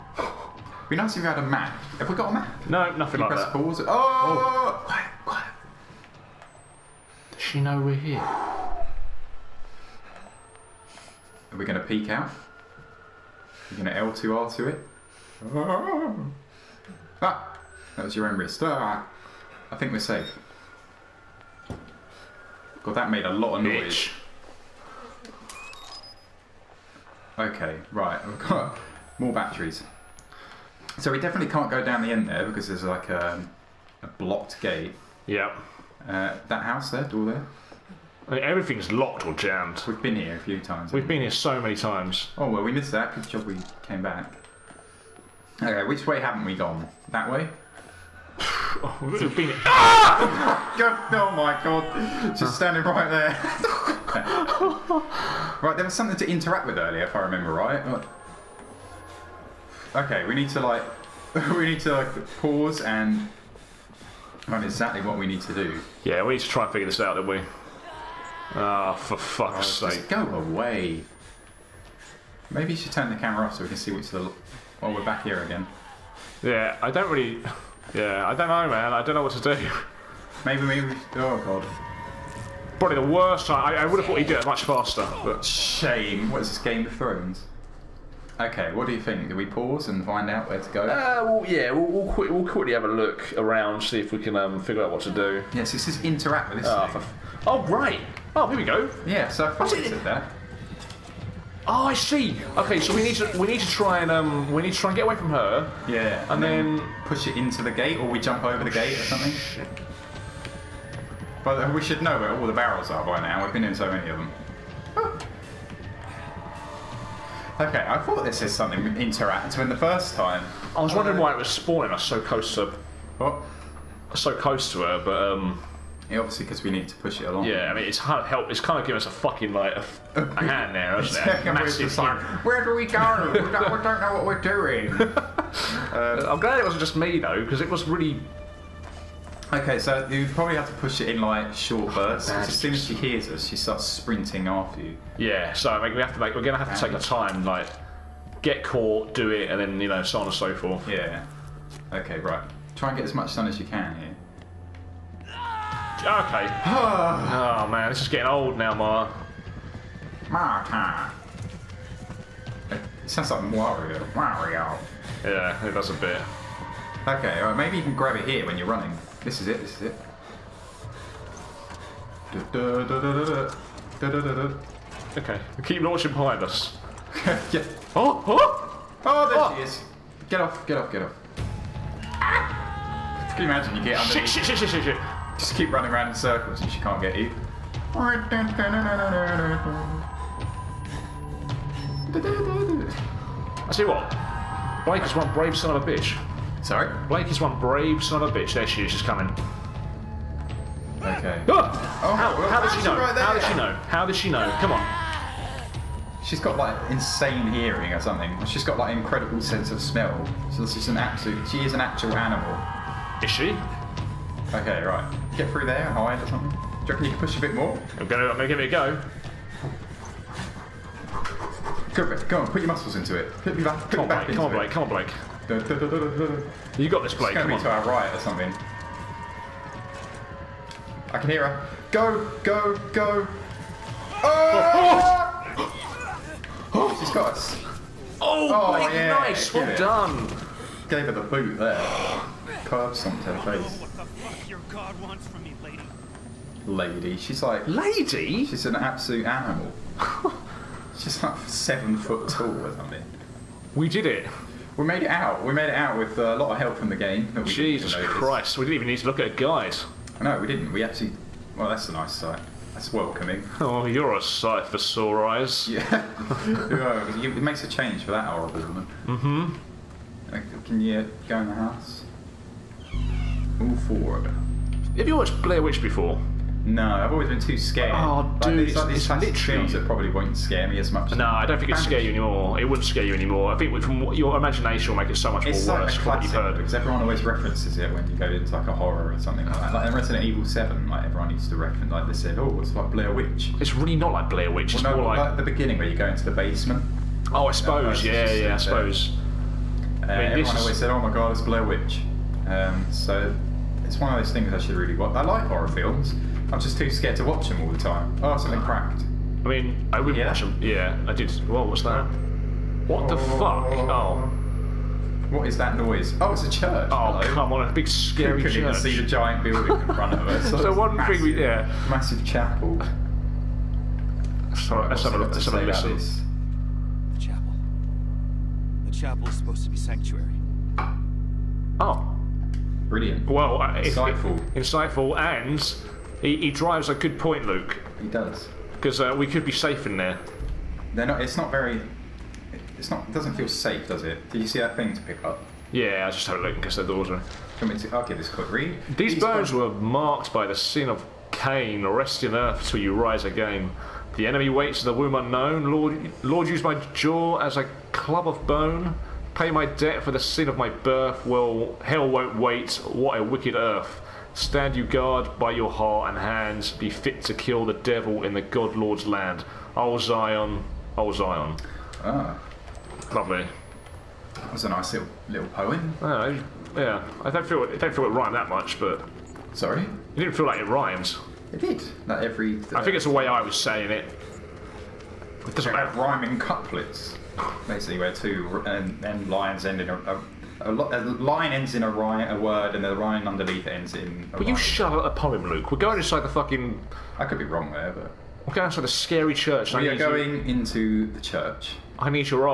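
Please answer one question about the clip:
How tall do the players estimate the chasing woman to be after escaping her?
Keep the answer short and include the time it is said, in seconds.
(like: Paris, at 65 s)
seven foot, at 251 s.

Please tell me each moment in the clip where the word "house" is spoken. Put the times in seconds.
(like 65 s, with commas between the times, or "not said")
36 s, 271 s.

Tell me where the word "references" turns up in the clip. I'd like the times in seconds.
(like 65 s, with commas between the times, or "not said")
287 s, 291 s.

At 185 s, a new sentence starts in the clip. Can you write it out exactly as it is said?
Just keep running around in circles and she can't get you.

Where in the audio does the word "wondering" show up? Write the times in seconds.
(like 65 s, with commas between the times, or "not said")
120 s.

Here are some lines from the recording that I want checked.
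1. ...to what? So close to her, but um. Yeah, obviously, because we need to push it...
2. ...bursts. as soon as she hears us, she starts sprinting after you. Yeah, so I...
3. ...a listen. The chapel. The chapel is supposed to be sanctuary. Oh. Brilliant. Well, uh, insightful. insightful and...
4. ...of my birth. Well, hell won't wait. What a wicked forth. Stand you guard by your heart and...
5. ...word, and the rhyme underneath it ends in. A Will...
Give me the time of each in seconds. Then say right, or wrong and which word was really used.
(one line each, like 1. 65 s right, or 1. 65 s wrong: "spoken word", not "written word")
1. 122 s right
2. 141 s right
3. 325 s right
4. 360 s wrong: "earth", not "forth"
5. 392 s right.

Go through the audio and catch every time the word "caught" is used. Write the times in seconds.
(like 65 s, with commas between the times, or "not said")
148 s.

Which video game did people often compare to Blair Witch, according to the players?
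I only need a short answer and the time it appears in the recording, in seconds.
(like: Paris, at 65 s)
Resident Evil Seven, at 289 s.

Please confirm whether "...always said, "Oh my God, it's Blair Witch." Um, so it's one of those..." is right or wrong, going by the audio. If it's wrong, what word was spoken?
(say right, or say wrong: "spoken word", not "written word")
right.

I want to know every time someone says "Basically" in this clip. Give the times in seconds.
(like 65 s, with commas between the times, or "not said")
387 s.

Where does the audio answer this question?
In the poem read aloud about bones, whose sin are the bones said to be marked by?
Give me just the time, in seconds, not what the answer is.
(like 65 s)
351 s.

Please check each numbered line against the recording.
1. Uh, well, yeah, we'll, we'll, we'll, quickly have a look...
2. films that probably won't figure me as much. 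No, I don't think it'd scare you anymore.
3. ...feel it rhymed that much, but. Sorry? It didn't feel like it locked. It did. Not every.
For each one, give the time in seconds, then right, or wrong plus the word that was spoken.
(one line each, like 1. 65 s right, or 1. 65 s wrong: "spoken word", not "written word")
1. 90 s right
2. 279 s wrong: "scare", not "figure"
3. 377 s wrong: "rhymed", not "locked".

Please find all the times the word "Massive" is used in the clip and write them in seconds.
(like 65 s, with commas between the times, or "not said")
131 s, 321 s.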